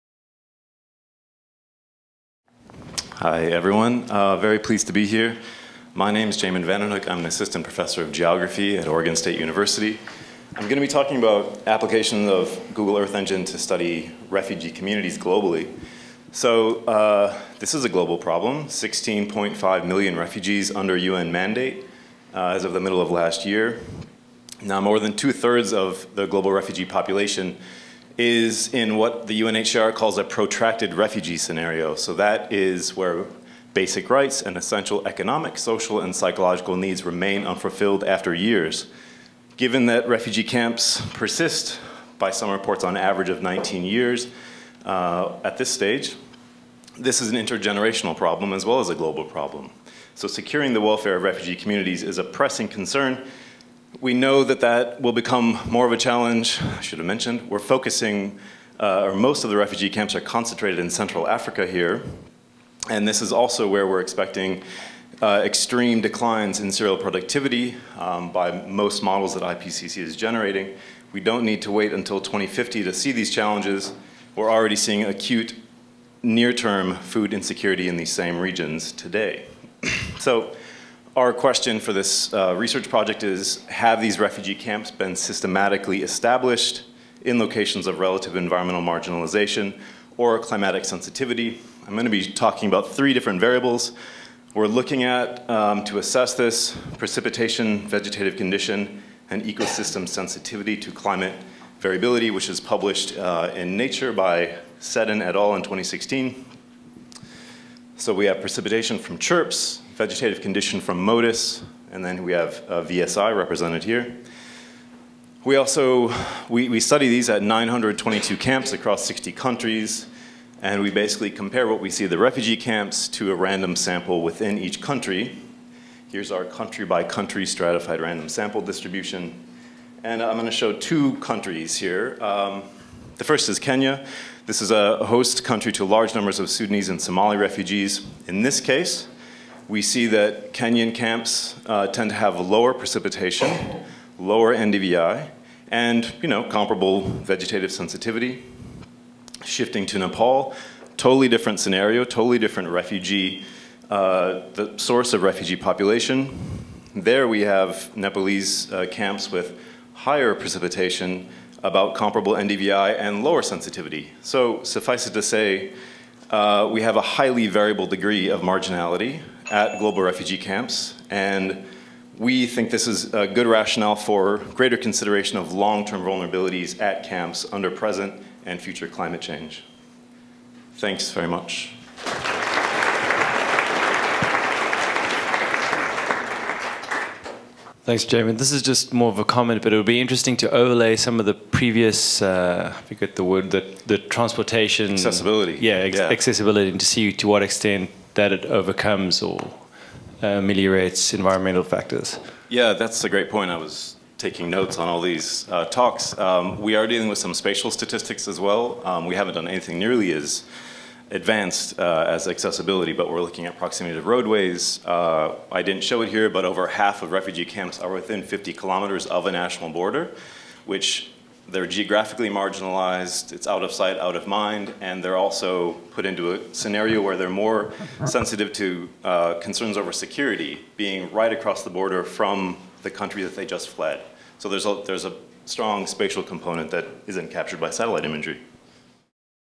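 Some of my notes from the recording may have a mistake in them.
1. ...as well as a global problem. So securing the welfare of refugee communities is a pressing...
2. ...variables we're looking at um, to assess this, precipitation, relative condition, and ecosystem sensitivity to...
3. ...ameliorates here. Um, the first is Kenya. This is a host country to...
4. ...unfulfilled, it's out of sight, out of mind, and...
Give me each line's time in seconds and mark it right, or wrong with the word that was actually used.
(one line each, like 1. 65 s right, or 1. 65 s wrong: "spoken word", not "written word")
1. 48 s right
2. 93 s wrong: "vegetative", not "relative"
3. 131 s wrong: "countries", not "ameliorates"
4. 222 s wrong: "marginalized", not "unfulfilled".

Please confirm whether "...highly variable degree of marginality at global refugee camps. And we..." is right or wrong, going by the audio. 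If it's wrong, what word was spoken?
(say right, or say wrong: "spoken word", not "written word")
right.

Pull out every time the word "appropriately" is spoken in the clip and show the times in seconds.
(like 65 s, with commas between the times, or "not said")
not said.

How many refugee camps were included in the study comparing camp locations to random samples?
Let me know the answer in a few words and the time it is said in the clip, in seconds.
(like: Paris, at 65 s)
922, at 117 s.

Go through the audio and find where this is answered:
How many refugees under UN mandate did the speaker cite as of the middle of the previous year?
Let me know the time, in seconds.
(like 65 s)
18 s.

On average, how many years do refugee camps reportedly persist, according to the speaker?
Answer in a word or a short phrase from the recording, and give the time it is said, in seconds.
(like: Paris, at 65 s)
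19 years, at 43 s.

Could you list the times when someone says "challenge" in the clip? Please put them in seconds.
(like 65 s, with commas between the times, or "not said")
55 s, 73 s.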